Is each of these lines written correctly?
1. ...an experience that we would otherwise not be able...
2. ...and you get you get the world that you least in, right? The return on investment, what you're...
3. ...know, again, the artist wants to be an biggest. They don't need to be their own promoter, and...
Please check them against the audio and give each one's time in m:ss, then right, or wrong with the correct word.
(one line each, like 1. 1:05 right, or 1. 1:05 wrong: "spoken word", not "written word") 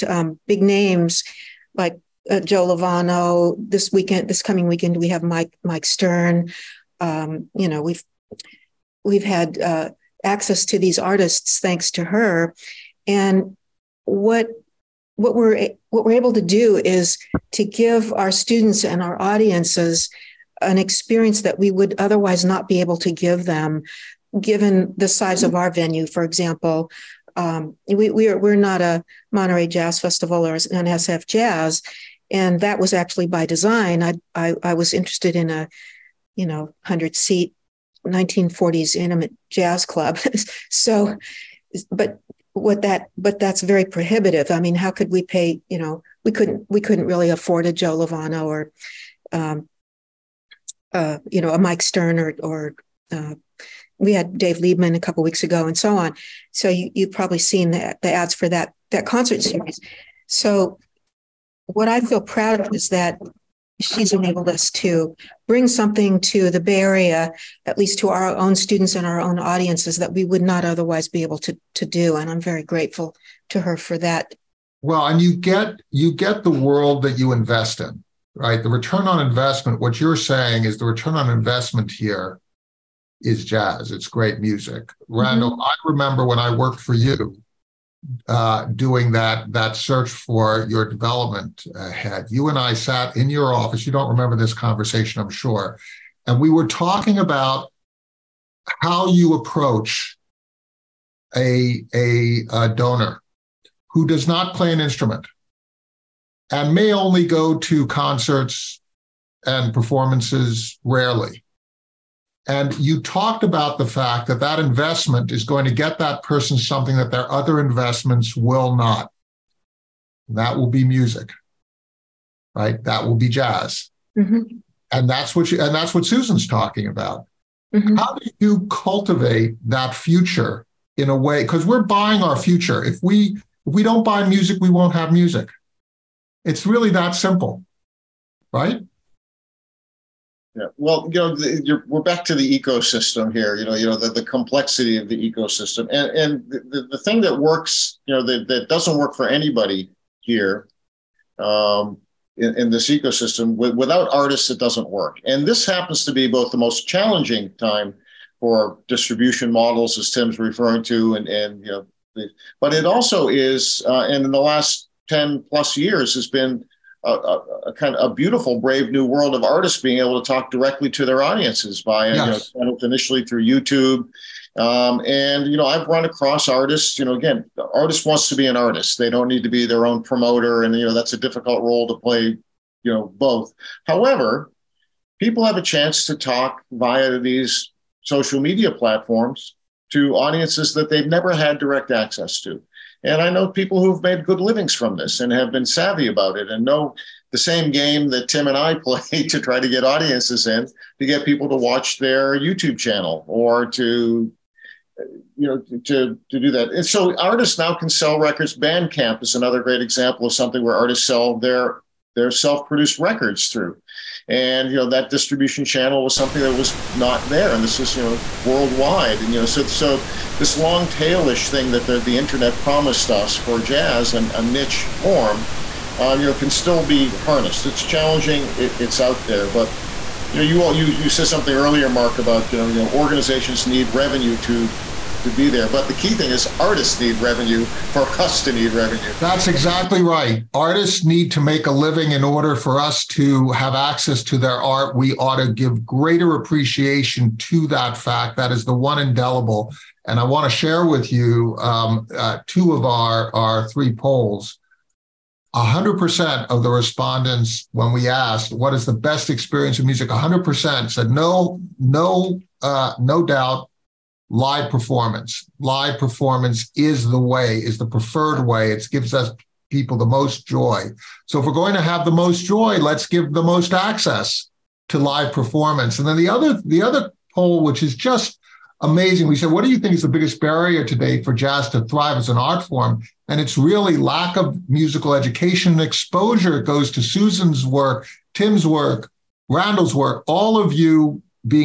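1. 0:20 right
2. 1:15 wrong: "invest", not "least"
3. 2:57 wrong: "artist", not "biggest".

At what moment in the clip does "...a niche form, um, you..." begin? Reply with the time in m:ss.
3:44.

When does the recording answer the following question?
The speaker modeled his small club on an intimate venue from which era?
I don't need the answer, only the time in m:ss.
0:38.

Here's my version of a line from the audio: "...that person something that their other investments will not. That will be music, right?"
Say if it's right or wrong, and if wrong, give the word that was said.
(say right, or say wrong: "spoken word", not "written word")
right.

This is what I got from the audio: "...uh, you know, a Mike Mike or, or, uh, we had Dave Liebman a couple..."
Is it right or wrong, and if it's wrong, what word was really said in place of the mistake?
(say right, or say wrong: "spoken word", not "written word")
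wrong: "Stern", not "Mike".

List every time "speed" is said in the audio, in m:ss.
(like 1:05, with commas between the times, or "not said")
not said.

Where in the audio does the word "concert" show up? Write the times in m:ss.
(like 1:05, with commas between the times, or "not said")
0:59, 1:47.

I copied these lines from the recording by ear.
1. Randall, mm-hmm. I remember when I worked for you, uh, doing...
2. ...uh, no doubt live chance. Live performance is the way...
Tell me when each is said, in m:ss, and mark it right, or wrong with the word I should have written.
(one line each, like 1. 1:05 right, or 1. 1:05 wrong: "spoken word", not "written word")
1. 1:25 right
2. 4:22 wrong: "performance", not "chance".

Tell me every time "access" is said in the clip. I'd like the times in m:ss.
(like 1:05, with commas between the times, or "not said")
0:10, 3:11, 4:03, 4:33.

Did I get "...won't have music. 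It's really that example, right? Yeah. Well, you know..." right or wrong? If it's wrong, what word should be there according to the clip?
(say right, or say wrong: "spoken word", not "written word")
wrong: "simple", not "example".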